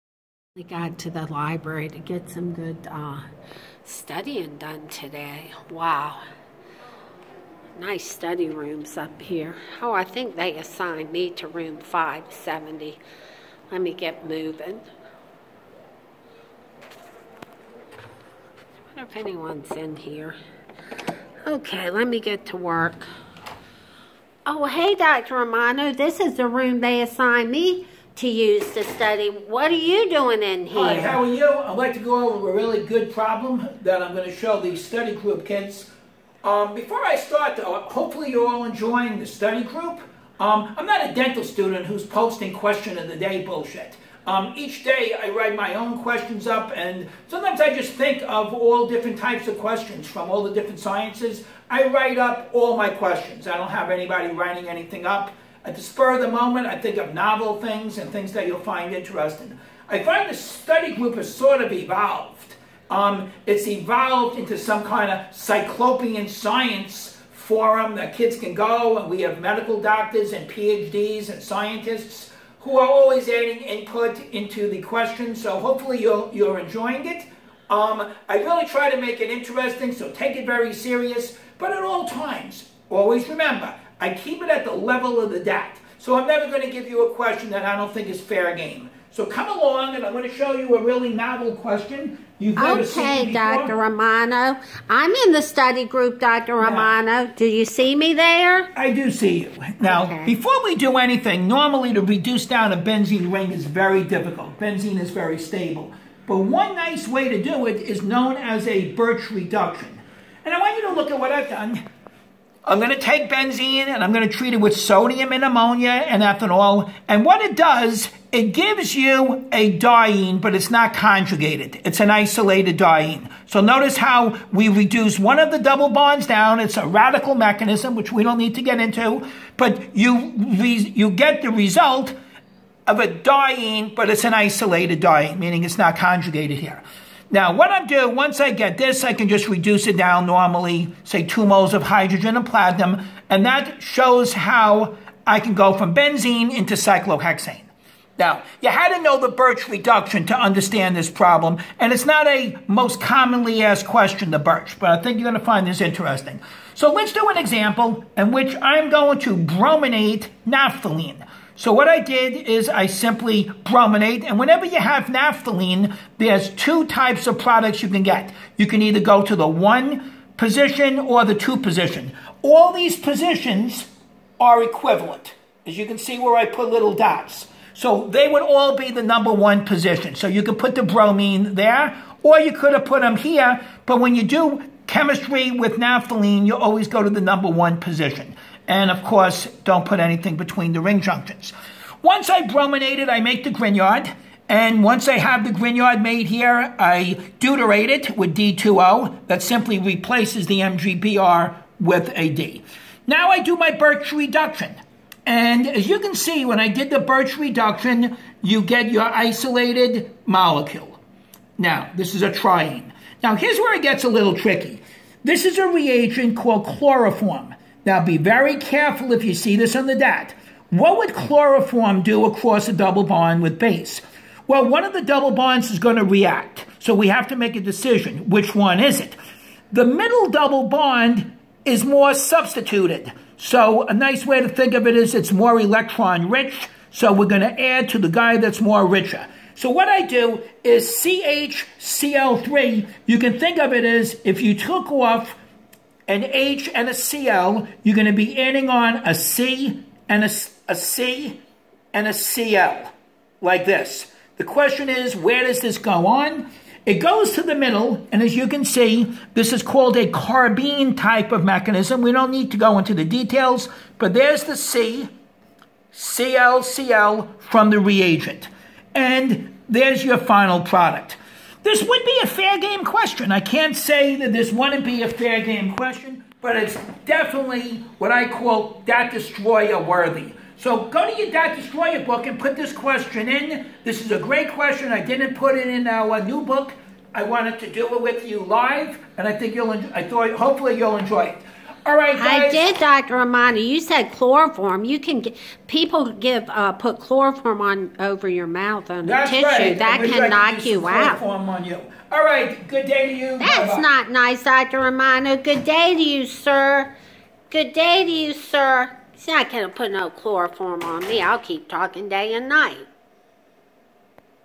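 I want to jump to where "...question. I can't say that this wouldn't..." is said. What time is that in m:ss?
4:32.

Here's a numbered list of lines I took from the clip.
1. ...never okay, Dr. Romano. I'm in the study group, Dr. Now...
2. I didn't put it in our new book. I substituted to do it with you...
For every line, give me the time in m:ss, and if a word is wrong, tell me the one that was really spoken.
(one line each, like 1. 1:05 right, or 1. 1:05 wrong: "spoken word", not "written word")
1. 1:32 right
2. 4:44 wrong: "wanted", not "substituted".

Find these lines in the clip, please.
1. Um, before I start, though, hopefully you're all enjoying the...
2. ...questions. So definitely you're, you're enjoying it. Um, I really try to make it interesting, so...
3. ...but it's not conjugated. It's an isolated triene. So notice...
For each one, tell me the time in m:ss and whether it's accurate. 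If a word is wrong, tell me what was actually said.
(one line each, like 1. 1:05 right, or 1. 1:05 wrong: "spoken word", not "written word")
1. 0:36 right
2. 1:14 wrong: "hopefully", not "definitely"
3. 2:00 wrong: "diene", not "triene".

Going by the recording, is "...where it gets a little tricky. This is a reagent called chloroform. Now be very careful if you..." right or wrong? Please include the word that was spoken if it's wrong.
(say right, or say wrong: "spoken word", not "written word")
right.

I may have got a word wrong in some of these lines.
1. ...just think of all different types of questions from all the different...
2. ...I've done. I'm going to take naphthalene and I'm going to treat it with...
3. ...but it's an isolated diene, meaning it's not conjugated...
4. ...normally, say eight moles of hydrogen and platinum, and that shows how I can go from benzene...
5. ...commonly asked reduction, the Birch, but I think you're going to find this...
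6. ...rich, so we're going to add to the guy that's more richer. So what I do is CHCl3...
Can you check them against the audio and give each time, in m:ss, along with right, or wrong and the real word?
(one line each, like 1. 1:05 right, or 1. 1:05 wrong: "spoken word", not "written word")
1. 0:47 right
2. 1:51 wrong: "benzene", not "naphthalene"
3. 2:13 right
4. 2:20 wrong: "two", not "eight"
5. 2:32 wrong: "question", not "reduction"
6. 3:56 right.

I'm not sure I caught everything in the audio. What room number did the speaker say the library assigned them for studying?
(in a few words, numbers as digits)
570.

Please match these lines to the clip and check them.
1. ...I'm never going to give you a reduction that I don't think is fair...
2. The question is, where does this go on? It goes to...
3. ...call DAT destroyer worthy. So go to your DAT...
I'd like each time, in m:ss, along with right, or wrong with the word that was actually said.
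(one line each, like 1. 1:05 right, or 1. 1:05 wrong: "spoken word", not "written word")
1. 1:26 wrong: "question", not "reduction"
2. 4:14 right
3. 4:38 right.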